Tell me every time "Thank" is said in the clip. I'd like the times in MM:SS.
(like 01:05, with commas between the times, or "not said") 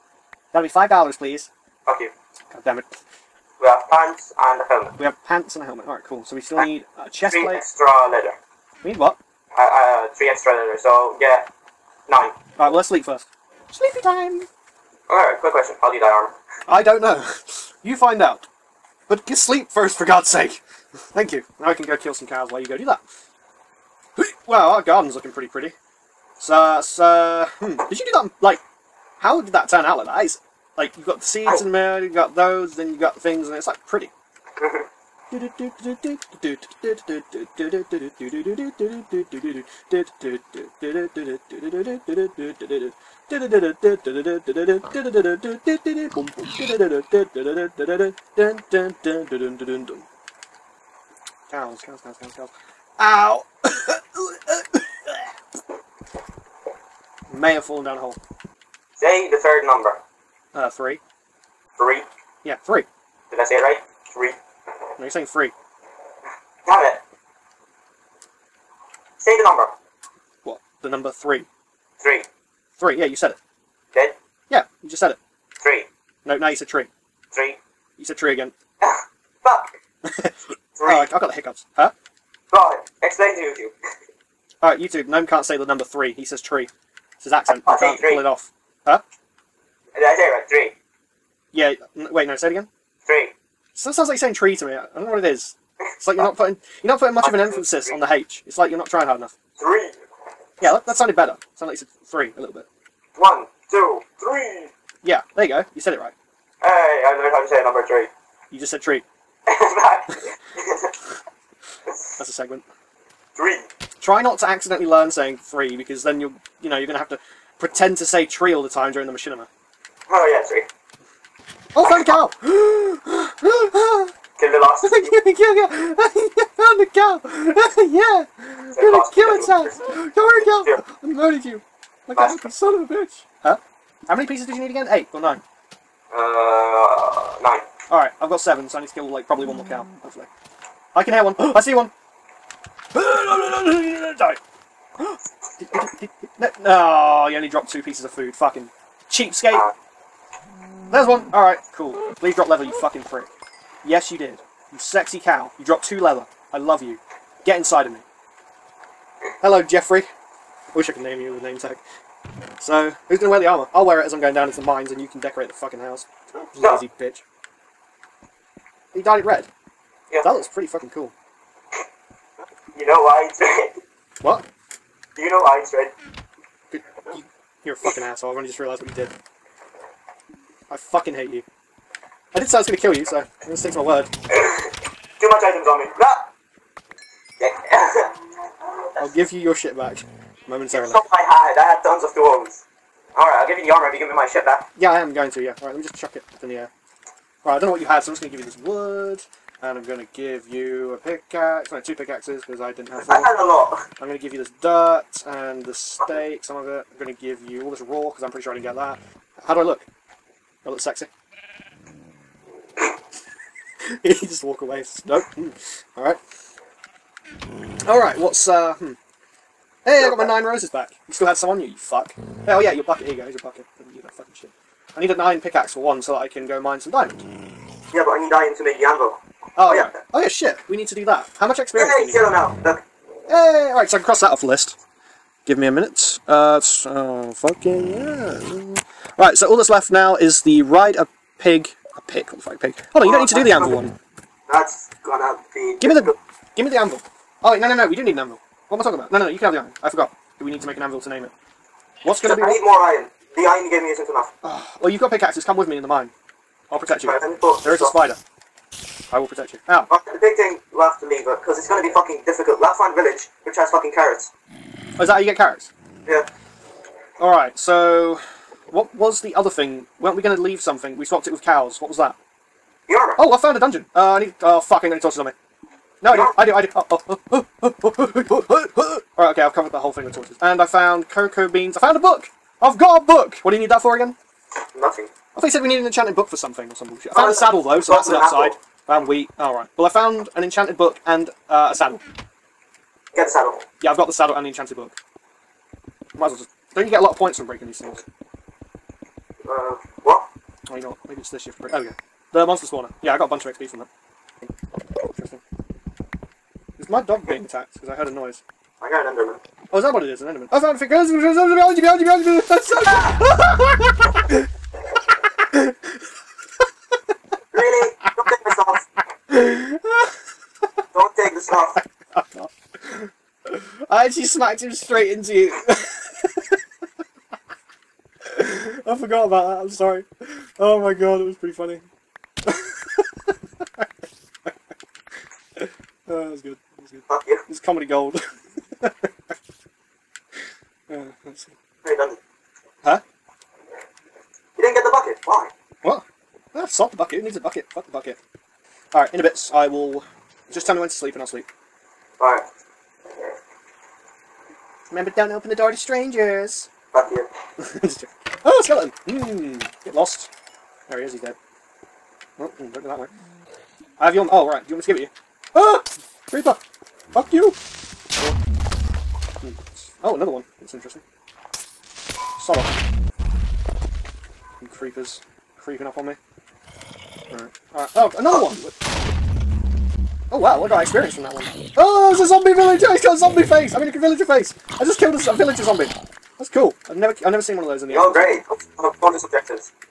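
00:20.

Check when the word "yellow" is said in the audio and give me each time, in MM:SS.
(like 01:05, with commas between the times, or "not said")
03:52.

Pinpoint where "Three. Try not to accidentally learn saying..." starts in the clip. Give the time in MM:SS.
01:53.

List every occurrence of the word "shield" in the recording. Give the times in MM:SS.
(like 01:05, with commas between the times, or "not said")
not said.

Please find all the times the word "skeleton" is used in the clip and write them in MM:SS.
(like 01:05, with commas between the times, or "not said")
05:58.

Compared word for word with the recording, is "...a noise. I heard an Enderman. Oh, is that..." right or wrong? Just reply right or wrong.
right.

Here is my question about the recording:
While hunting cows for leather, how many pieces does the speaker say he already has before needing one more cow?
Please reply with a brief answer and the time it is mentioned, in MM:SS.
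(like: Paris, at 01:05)
7, at 02:18.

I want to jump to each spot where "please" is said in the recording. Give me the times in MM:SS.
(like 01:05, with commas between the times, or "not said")
00:01, 02:32.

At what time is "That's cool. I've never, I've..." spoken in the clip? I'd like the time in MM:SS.
06:26.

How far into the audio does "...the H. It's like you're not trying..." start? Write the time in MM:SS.
01:37.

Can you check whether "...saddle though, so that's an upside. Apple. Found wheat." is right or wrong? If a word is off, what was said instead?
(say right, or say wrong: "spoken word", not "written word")
right.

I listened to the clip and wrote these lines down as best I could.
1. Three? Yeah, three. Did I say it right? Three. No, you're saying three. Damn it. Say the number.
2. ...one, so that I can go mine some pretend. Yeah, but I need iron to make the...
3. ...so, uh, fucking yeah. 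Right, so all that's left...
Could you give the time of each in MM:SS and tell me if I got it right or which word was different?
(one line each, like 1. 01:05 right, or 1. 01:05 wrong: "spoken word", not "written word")
1. 01:01 right
2. 03:45 wrong: "diamond", not "pretend"
3. 03:56 right.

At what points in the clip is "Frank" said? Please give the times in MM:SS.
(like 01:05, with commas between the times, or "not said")
not said.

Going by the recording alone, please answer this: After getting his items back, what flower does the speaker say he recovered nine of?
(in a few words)
Roses.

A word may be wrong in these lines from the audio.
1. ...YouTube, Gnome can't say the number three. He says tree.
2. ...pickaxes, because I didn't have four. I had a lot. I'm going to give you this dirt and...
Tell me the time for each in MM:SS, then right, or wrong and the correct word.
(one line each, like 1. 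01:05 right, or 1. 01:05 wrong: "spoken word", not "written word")
1. 01:24 right
2. 03:21 right.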